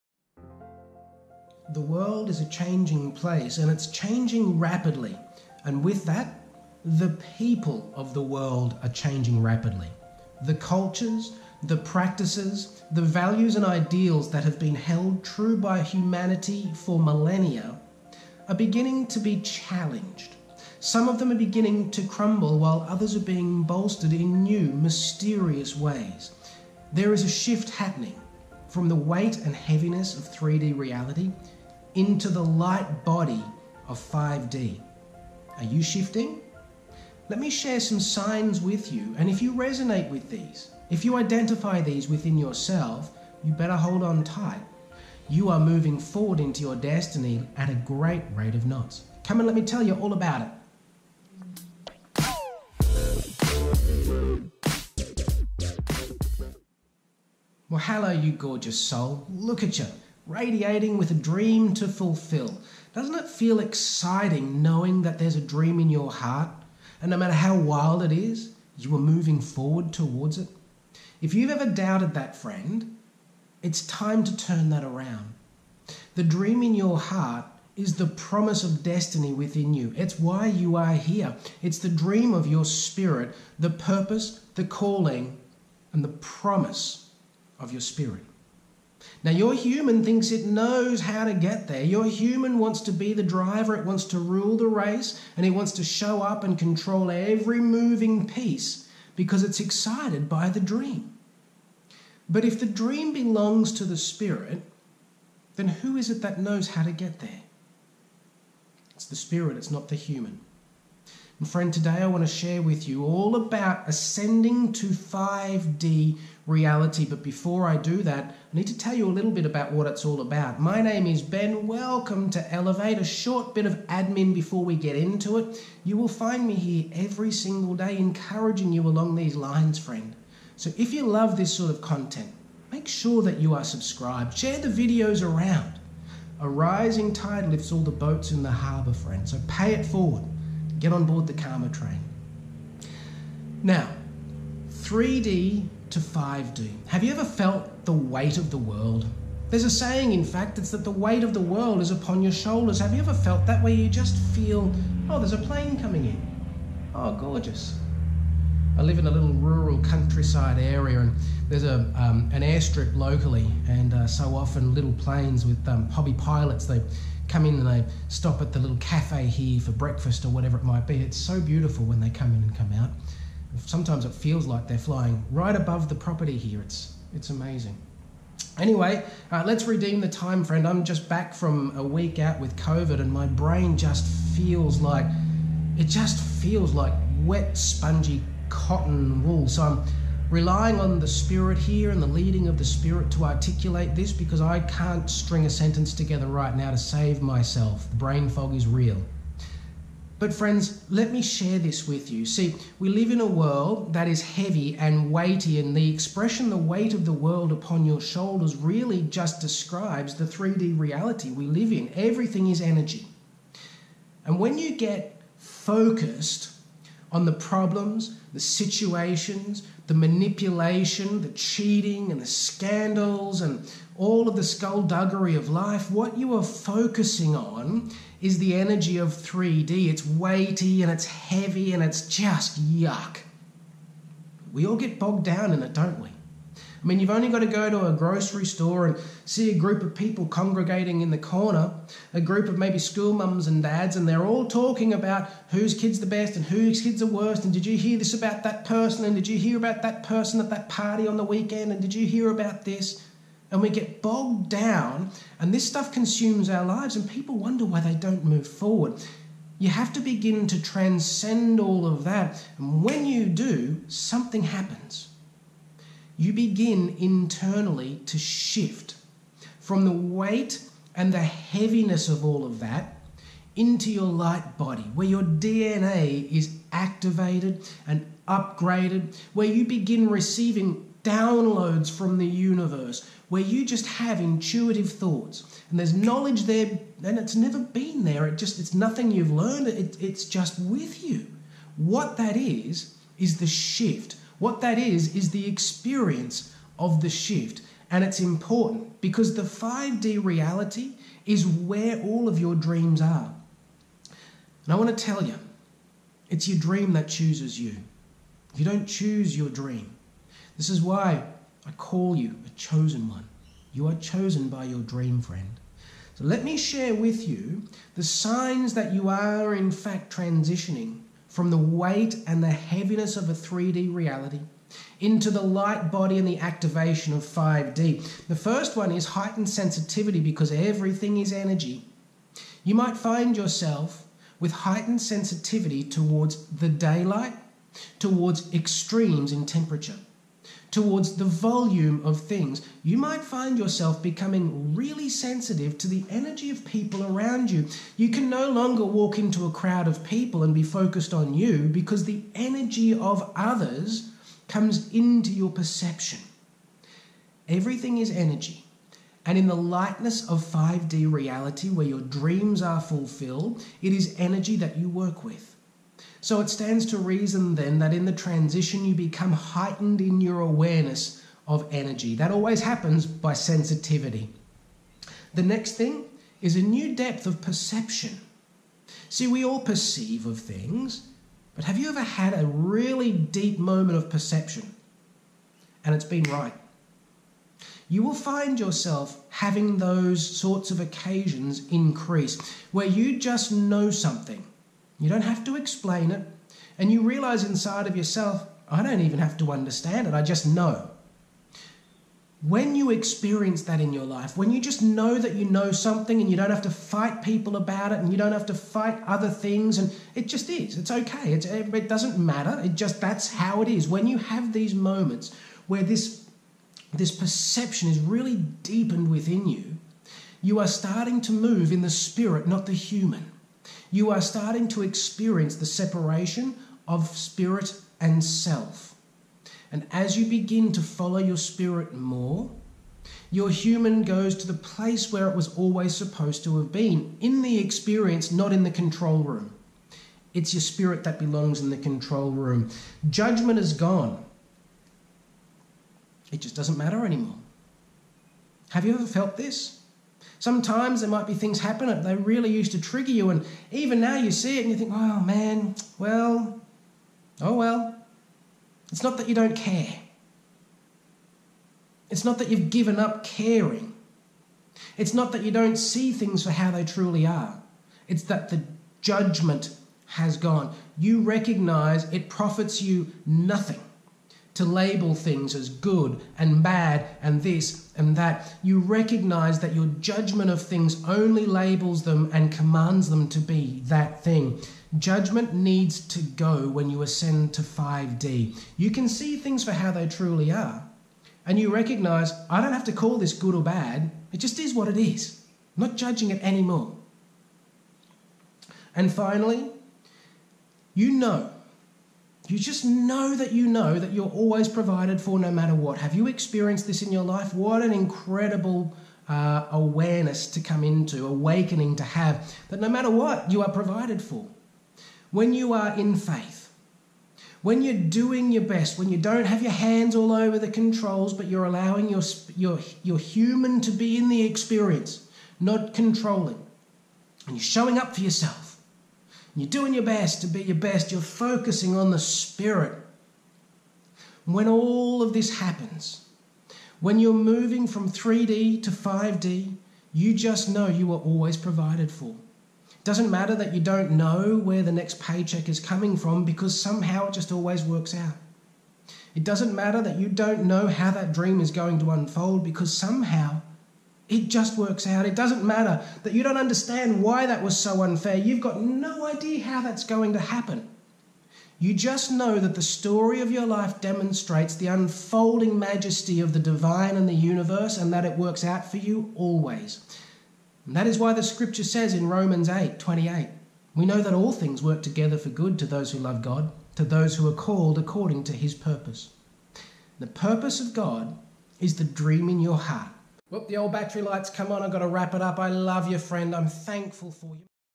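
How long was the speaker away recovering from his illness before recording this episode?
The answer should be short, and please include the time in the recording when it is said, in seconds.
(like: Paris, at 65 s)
a week, at 181 s.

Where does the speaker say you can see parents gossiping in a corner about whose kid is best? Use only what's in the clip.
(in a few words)
grocery store.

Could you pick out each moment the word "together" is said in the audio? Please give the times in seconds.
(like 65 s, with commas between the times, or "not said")
195 s, 575 s.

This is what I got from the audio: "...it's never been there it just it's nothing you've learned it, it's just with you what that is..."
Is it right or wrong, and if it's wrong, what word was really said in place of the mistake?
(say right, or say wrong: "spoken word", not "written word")
right.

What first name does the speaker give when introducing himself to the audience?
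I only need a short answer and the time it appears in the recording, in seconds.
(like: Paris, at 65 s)
Ben, at 121 s.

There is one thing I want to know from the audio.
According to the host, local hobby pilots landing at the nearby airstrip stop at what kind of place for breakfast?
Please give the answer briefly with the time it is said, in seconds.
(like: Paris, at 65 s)
little cafe, at 168 s.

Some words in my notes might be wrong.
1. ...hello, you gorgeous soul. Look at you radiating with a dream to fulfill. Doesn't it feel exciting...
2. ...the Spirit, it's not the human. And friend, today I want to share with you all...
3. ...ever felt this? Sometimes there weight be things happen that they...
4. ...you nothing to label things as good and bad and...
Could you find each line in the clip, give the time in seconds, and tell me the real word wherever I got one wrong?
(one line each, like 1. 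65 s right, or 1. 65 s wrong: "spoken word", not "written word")
1. 57 s right
2. 109 s right
3. 448 s wrong: "might", not "weight"
4. 472 s right.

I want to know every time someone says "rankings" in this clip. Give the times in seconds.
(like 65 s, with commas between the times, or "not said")
not said.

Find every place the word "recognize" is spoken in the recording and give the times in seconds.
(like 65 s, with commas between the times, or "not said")
471 s, 478 s, 491 s.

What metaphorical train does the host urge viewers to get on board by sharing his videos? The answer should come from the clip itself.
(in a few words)
Karma train.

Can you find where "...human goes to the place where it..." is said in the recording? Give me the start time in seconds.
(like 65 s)
433 s.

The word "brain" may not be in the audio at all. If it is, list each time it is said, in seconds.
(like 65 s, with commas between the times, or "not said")
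183 s, 197 s.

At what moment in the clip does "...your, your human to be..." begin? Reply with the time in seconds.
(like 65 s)
522 s.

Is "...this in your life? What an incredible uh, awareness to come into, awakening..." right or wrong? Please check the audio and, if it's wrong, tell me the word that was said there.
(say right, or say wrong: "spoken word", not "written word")
right.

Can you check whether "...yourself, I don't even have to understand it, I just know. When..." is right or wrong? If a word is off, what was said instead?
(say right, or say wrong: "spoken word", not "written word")
right.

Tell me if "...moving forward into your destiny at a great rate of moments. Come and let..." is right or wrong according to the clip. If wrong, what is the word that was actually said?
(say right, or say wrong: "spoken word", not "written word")
wrong: "knots", not "moments".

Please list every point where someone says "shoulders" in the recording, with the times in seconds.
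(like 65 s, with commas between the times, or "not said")
152 s, 207 s.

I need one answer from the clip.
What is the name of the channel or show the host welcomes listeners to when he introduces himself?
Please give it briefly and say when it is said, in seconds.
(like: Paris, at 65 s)
Elevate, at 122 s.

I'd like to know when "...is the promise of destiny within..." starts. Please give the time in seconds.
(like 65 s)
77 s.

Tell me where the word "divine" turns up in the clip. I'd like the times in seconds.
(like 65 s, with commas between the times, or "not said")
566 s.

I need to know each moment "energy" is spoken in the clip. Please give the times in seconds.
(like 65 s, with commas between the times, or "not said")
212 s, 228 s, 331 s, 346 s, 352 s, 358 s, 364 s, 371 s.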